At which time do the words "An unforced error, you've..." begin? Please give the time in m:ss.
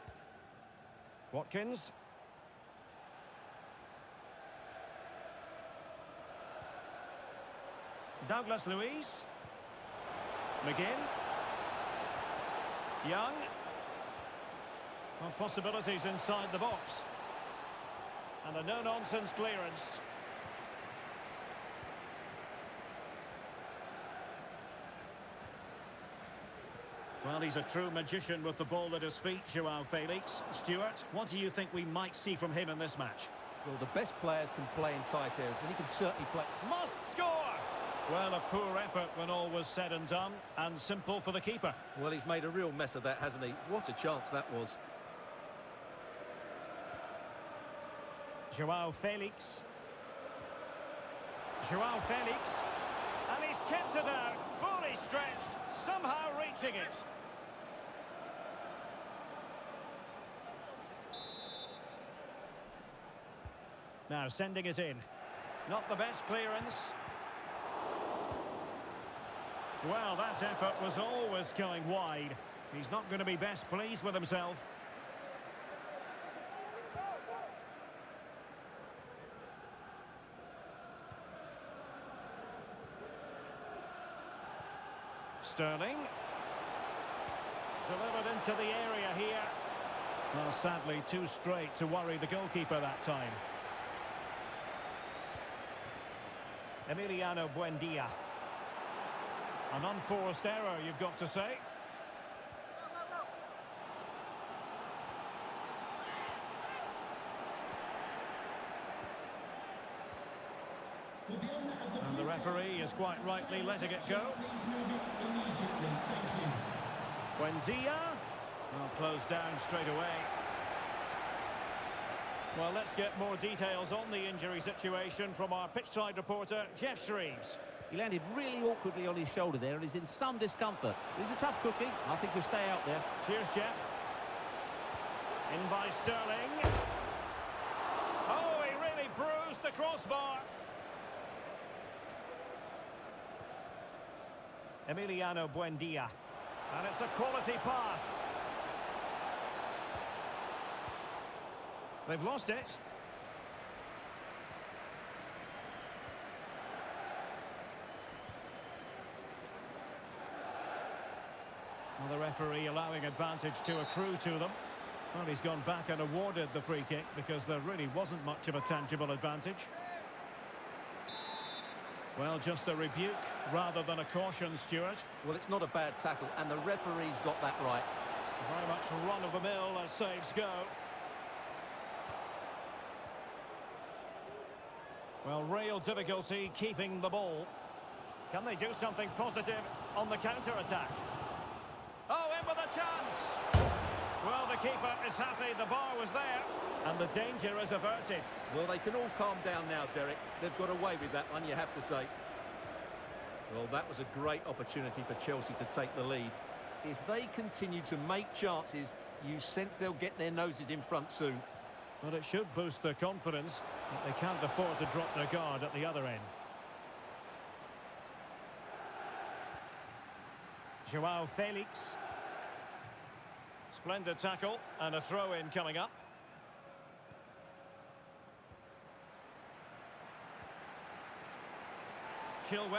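1:39.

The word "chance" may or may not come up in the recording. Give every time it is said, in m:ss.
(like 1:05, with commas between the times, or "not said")
0:44, 3:12, 3:28.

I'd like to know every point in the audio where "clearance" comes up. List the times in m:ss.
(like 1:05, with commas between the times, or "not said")
0:19, 1:06.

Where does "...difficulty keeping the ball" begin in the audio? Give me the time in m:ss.
3:05.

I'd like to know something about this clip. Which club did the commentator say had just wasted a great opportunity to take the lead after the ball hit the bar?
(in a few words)
Chelsea.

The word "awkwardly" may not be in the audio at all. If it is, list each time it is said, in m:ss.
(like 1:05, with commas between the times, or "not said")
2:08.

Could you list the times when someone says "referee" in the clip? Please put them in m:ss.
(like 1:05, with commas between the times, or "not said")
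1:52, 2:42, 2:56.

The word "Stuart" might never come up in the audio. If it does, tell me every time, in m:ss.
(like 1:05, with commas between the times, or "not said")
0:30, 2:54.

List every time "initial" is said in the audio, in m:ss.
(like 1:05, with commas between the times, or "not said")
not said.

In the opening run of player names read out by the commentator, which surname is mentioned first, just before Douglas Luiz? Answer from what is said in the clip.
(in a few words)
Watkins.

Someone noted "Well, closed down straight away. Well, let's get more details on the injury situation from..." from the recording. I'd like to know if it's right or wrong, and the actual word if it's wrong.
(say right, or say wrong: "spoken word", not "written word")
right.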